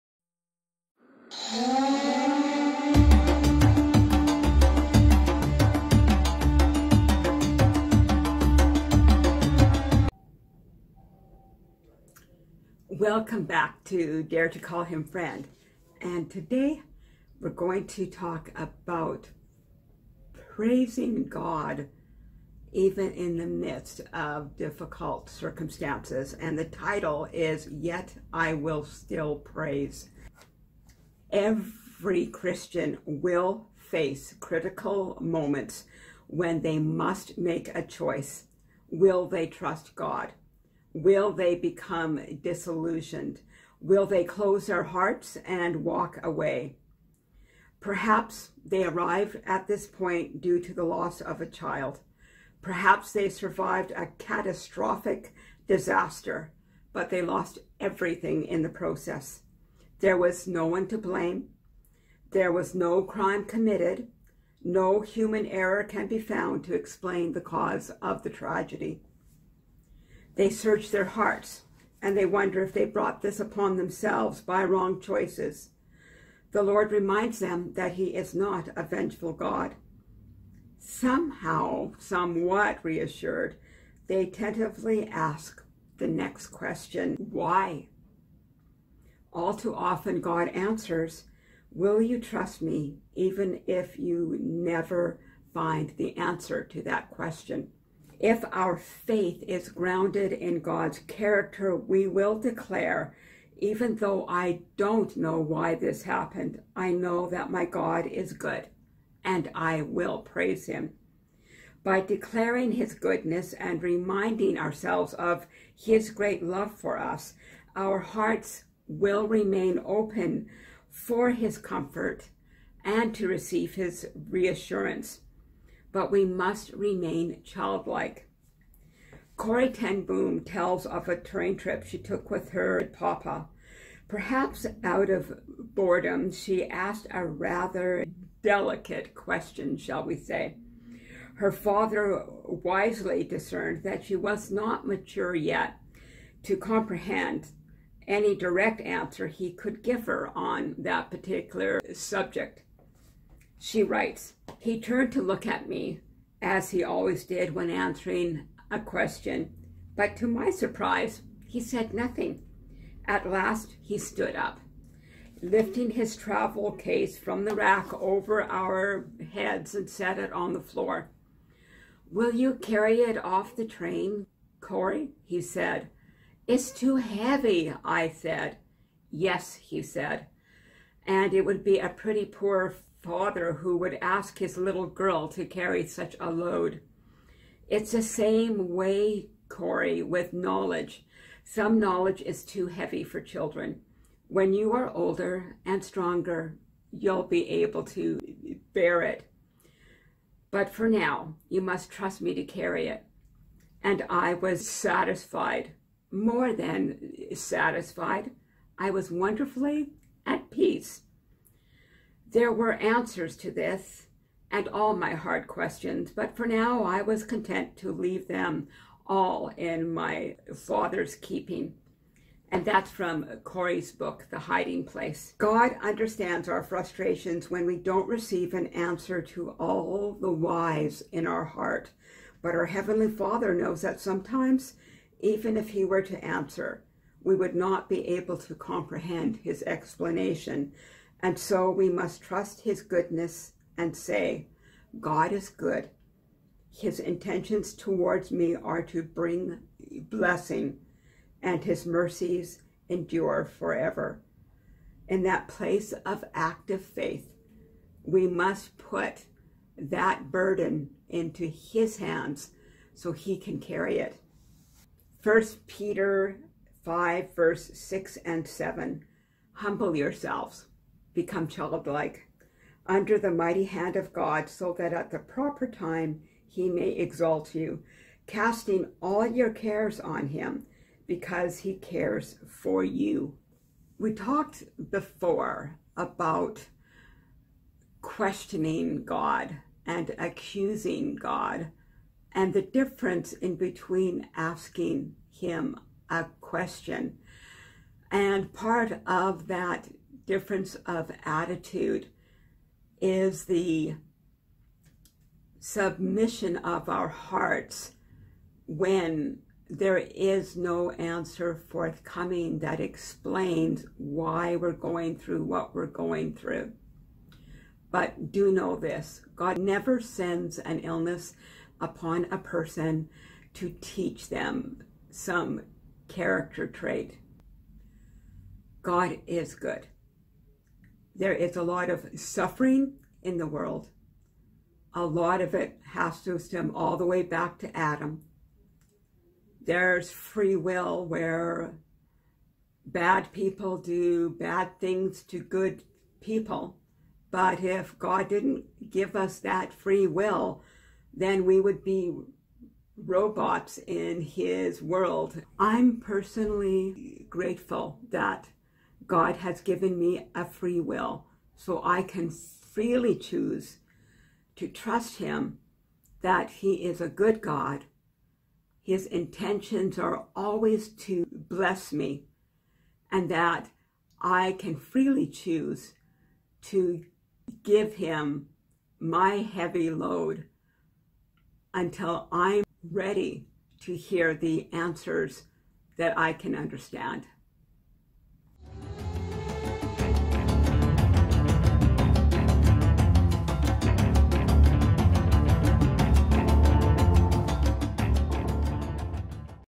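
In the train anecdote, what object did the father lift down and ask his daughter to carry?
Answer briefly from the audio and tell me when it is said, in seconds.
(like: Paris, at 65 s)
His travel case, at 166 s.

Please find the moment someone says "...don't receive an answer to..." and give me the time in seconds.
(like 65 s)
227 s.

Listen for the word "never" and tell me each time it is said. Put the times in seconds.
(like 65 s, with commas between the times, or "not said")
94 s, 319 s.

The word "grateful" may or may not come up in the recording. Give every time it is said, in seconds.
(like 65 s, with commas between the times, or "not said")
357 s.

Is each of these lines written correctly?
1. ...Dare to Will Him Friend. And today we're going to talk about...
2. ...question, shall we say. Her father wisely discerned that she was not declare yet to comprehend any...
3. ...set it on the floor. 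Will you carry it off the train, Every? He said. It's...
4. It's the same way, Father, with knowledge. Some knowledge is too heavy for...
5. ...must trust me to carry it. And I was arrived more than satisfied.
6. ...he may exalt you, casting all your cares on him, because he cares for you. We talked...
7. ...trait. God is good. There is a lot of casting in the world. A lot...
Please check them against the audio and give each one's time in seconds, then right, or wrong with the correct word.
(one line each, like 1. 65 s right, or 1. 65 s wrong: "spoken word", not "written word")
1. 14 s wrong: "Call", not "Will"
2. 139 s wrong: "mature", not "declare"
3. 169 s wrong: "Corrie", not "Every"
4. 187 s wrong: "Corrie", not "Father"
5. 201 s wrong: "satisfied", not "arrived"
6. 276 s right
7. 326 s wrong: "suffering", not "casting".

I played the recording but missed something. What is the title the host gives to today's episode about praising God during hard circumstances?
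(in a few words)
Yet I Will Still Praise.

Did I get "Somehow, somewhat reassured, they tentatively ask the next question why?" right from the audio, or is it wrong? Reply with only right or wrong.
right.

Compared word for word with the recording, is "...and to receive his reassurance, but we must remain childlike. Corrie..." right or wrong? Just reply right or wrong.
right.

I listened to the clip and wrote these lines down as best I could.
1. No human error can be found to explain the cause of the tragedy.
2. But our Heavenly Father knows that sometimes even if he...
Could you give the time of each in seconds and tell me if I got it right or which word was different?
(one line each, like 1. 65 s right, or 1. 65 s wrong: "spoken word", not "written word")
1. 64 s right
2. 232 s right.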